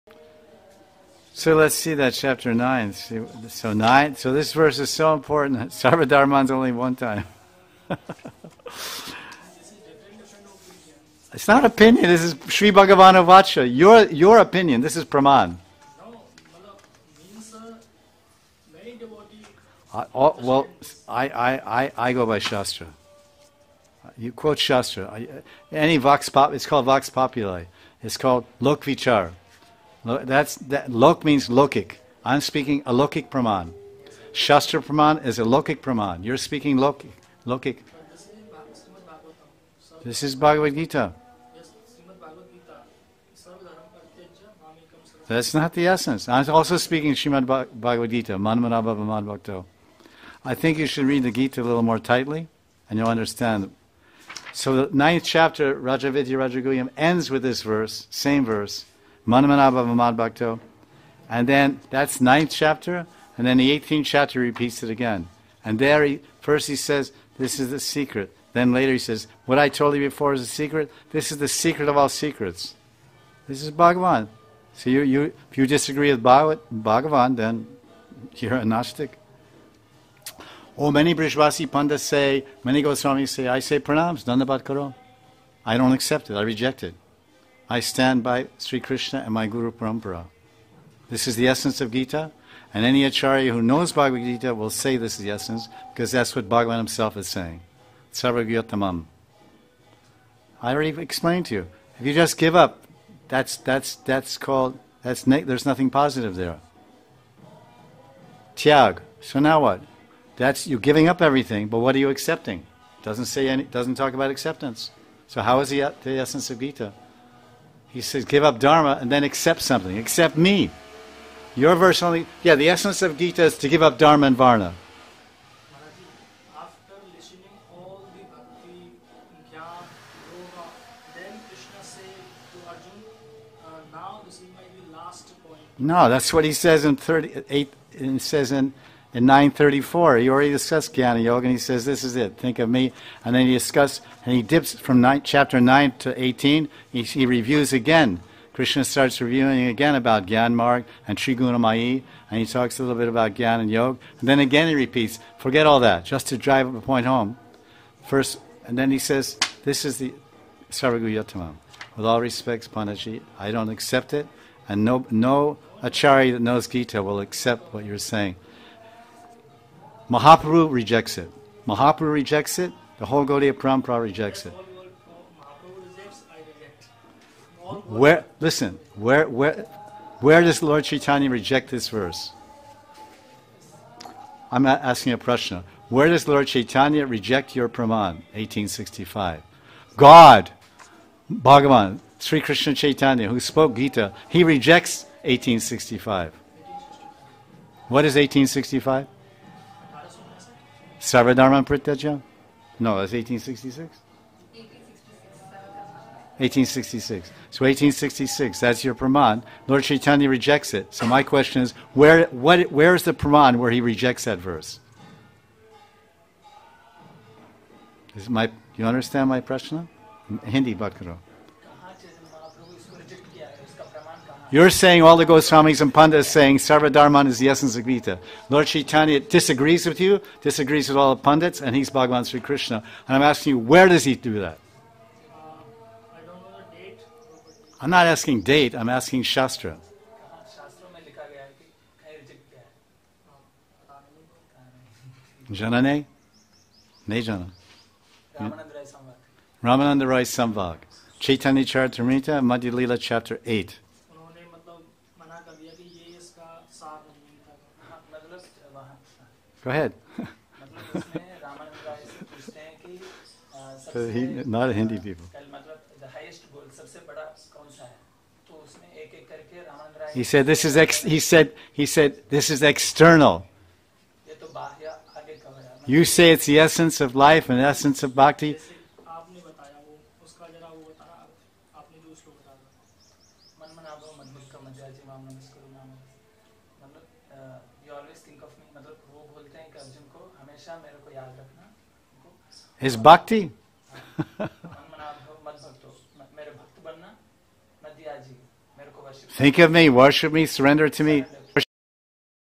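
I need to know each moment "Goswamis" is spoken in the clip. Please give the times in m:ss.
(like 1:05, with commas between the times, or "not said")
1:22, 3:45.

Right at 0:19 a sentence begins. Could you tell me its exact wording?
I, uh, oh, well, I, I, I, I go by Shastra.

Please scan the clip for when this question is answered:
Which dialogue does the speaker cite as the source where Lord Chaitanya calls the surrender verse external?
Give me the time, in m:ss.
4:09.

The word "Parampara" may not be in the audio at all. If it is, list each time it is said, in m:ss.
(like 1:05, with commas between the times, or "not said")
1:29, 2:53.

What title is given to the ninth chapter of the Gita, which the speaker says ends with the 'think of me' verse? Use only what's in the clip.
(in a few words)
Rajavidya Rajaguhyam.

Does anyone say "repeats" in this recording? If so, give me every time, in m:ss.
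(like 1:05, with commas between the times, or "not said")
1:04, 2:34.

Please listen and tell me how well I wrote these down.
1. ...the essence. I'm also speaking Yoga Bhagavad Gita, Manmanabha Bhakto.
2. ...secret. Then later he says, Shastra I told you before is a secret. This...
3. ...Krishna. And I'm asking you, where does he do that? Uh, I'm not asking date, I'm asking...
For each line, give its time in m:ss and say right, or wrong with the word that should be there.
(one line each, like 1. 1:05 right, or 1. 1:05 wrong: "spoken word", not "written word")
1. 0:45 wrong: "Srimad", not "Yoga"
2. 1:07 wrong: "What", not "Shastra"
3. 3:52 right.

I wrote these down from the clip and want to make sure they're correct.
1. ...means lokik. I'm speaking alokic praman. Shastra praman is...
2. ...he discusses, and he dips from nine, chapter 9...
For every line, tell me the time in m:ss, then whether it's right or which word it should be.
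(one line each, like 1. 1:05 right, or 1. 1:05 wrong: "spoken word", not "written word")
1. 0:31 right
2. 2:23 right.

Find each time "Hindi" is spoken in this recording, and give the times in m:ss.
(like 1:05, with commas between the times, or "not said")
3:40, 4:24.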